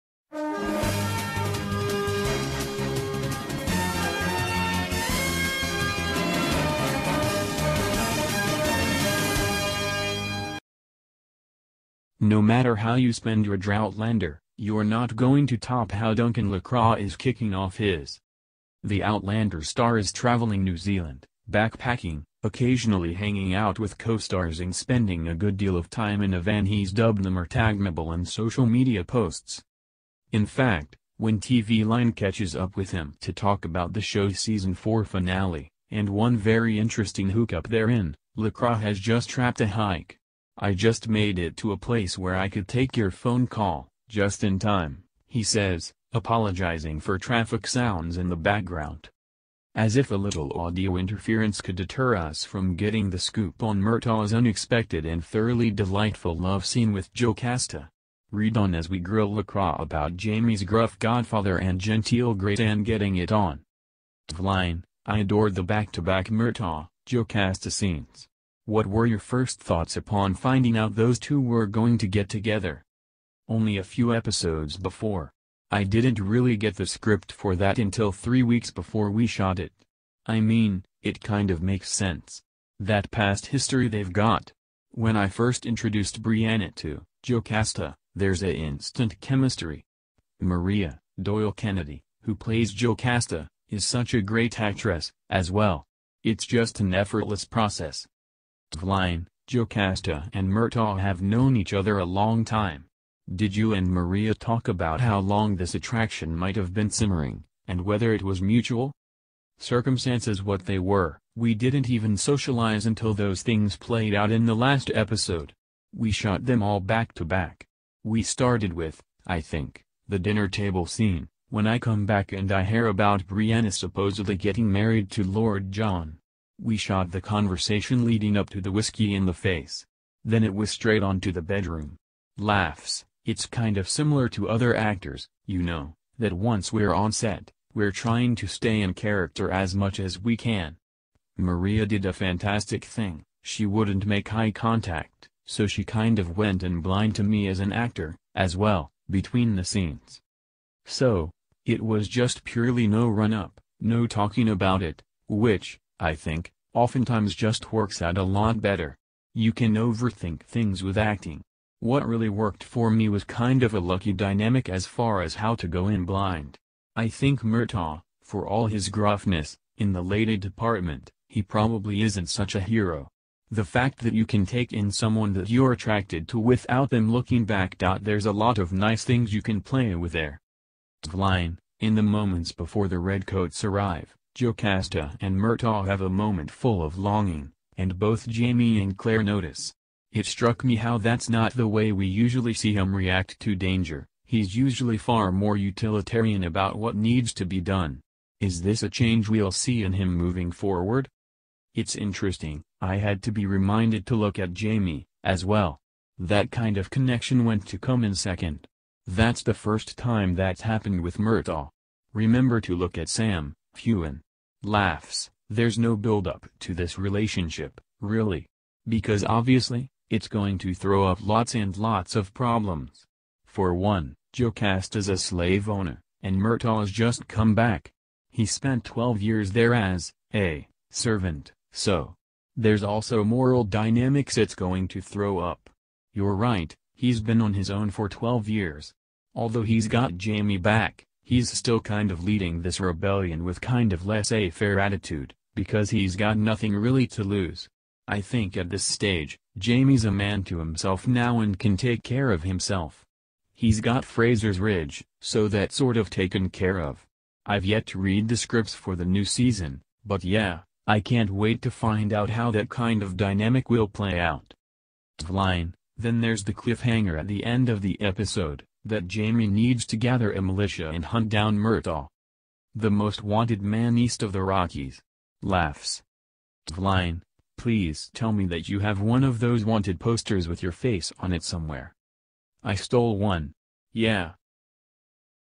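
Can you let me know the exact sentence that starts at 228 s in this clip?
He spent 12 years there as a servant, so.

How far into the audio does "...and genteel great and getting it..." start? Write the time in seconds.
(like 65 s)
61 s.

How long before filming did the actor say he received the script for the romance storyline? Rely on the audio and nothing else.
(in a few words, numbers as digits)
3 weeks.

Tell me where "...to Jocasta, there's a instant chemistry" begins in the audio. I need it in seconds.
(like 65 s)
86 s.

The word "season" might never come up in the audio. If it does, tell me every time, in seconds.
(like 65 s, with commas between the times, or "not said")
34 s, 259 s.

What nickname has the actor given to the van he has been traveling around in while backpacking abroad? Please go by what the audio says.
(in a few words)
the Murtaghmobile.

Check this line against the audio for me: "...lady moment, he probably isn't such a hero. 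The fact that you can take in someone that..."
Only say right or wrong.
wrong.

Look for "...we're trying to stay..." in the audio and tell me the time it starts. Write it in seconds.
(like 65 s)
137 s.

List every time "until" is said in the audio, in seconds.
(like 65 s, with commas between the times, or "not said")
77 s, 112 s.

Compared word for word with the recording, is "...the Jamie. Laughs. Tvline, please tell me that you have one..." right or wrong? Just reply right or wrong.
wrong.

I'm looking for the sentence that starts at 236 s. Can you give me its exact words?
You're right, he's been on his own for 12 years.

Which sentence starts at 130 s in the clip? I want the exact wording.
Then it was straight on to the bedroom.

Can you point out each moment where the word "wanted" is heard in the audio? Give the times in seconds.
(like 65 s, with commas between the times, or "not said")
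273 s, 279 s.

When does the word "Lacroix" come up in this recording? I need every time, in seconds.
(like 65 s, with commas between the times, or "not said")
16 s, 38 s, 59 s.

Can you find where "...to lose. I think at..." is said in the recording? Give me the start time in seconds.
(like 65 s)
247 s.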